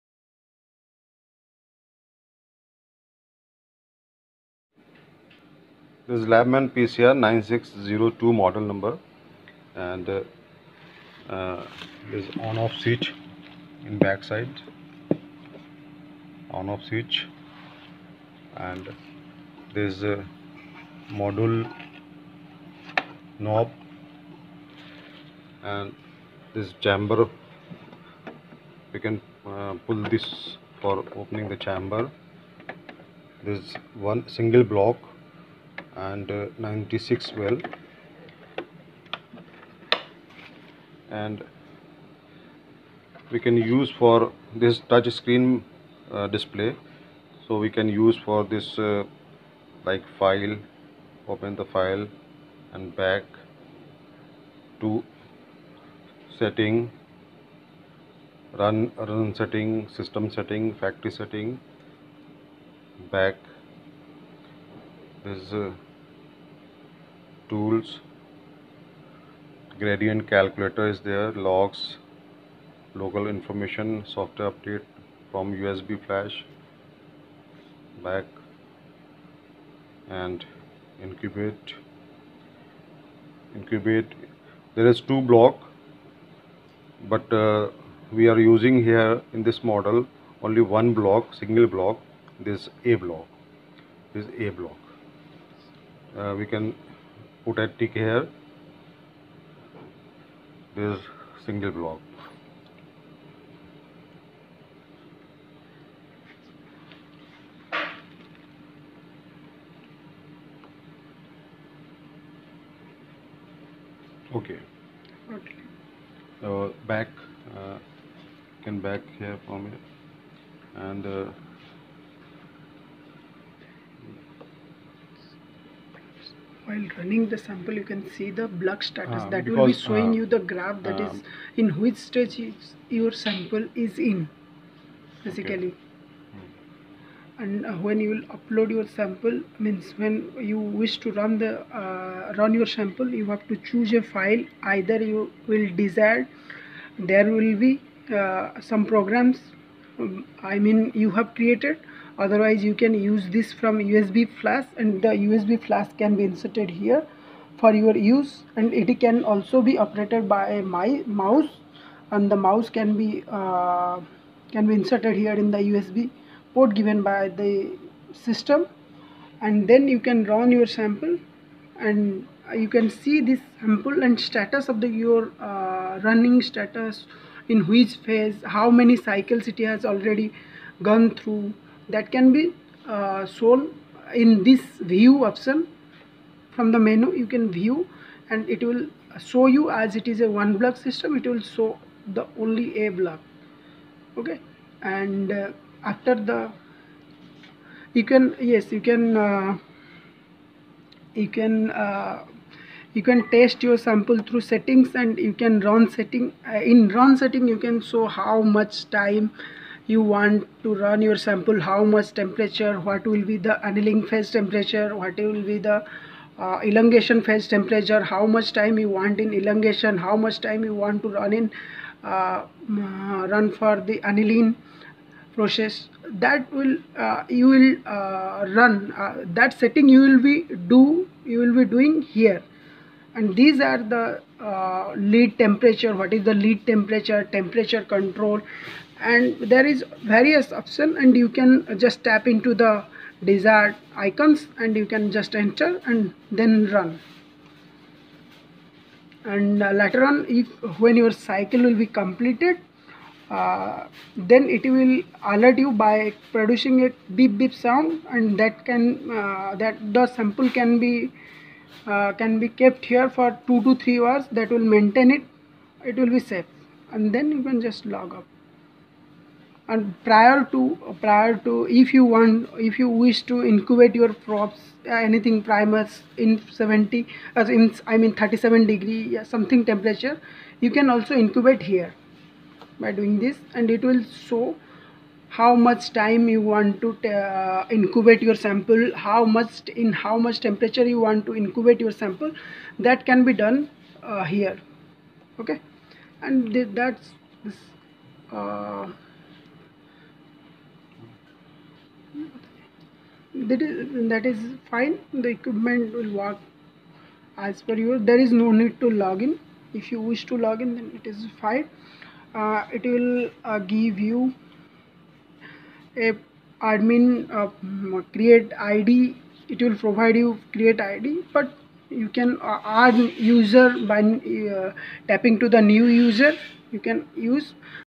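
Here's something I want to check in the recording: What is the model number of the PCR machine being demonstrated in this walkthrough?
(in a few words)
9602.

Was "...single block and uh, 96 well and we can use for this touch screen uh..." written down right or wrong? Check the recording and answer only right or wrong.
right.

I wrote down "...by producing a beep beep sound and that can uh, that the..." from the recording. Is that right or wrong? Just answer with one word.
right.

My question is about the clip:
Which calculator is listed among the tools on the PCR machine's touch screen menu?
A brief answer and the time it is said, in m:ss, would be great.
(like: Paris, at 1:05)
Gradient calculator, at 1:09.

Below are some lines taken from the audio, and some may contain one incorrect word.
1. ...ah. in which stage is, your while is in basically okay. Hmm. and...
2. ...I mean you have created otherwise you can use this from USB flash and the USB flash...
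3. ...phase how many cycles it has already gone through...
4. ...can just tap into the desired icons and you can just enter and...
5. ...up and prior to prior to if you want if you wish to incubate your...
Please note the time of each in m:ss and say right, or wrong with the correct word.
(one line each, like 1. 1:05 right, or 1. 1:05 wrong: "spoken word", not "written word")
1. 2:11 wrong: "sample", not "while"
2. 2:30 right
3. 2:58 right
4. 4:01 right
5. 4:28 right.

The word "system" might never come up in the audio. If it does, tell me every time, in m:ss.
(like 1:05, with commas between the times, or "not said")
0:59, 2:48, 3:10.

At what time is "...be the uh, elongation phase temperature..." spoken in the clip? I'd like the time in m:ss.
3:35.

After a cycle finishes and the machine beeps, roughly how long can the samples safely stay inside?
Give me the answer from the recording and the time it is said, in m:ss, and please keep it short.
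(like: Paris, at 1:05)
2 to 3 hours, at 4:23.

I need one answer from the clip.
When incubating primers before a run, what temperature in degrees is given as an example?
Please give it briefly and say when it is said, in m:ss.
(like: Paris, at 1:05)
37 degrees, at 4:38.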